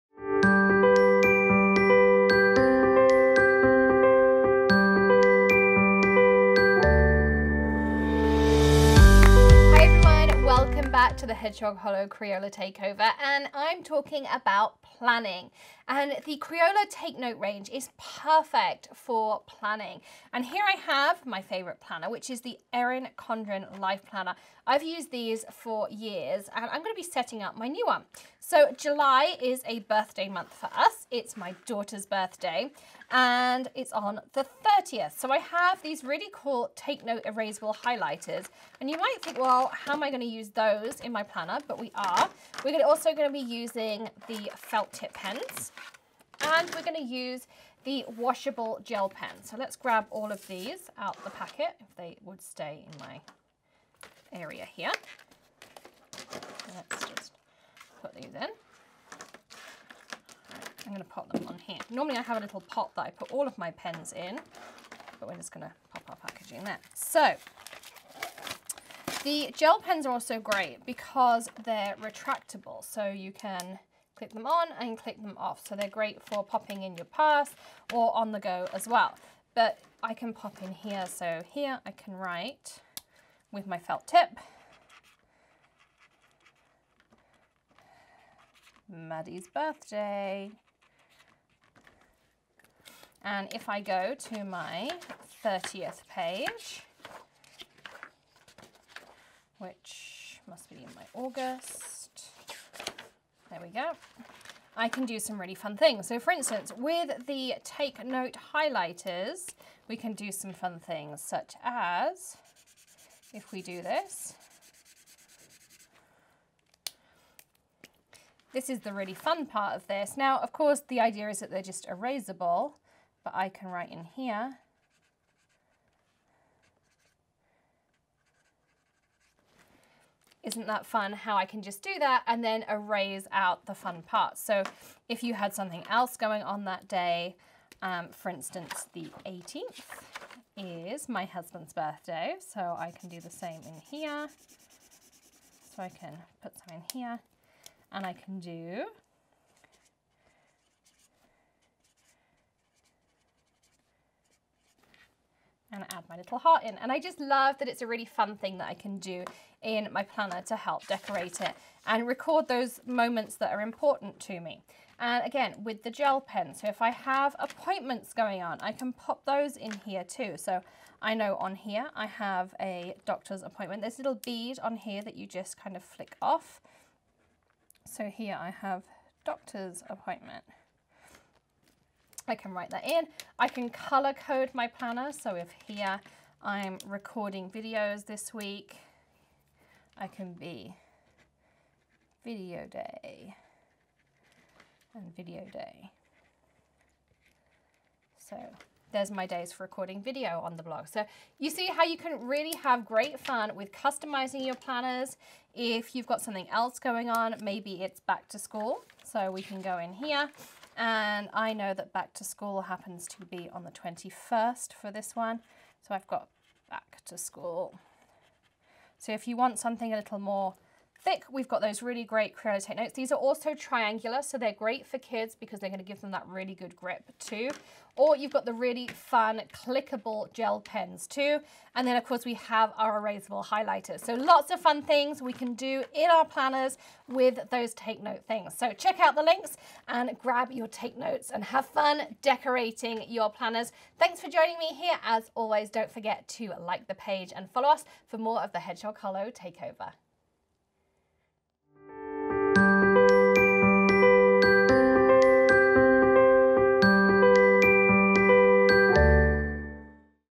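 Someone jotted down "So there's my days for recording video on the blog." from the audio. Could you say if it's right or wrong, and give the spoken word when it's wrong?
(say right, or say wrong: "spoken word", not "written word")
right.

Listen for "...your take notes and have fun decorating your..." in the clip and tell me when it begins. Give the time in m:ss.
4:00.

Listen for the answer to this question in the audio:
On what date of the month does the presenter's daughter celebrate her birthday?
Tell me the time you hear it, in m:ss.
0:33.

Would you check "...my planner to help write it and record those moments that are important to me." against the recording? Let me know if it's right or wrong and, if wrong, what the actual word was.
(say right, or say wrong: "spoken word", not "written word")
wrong: "decorate", not "write".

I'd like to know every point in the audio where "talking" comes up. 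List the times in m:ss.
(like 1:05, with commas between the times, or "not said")
0:13.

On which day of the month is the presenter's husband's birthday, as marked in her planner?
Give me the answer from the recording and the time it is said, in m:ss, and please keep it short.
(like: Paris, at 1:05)
18th, at 2:18.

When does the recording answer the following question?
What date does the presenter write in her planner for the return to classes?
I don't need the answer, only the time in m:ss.
3:33.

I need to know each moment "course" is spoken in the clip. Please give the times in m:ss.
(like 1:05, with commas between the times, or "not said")
2:00, 3:52.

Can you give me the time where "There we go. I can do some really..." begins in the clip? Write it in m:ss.
1:43.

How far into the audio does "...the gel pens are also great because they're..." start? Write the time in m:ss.
1:09.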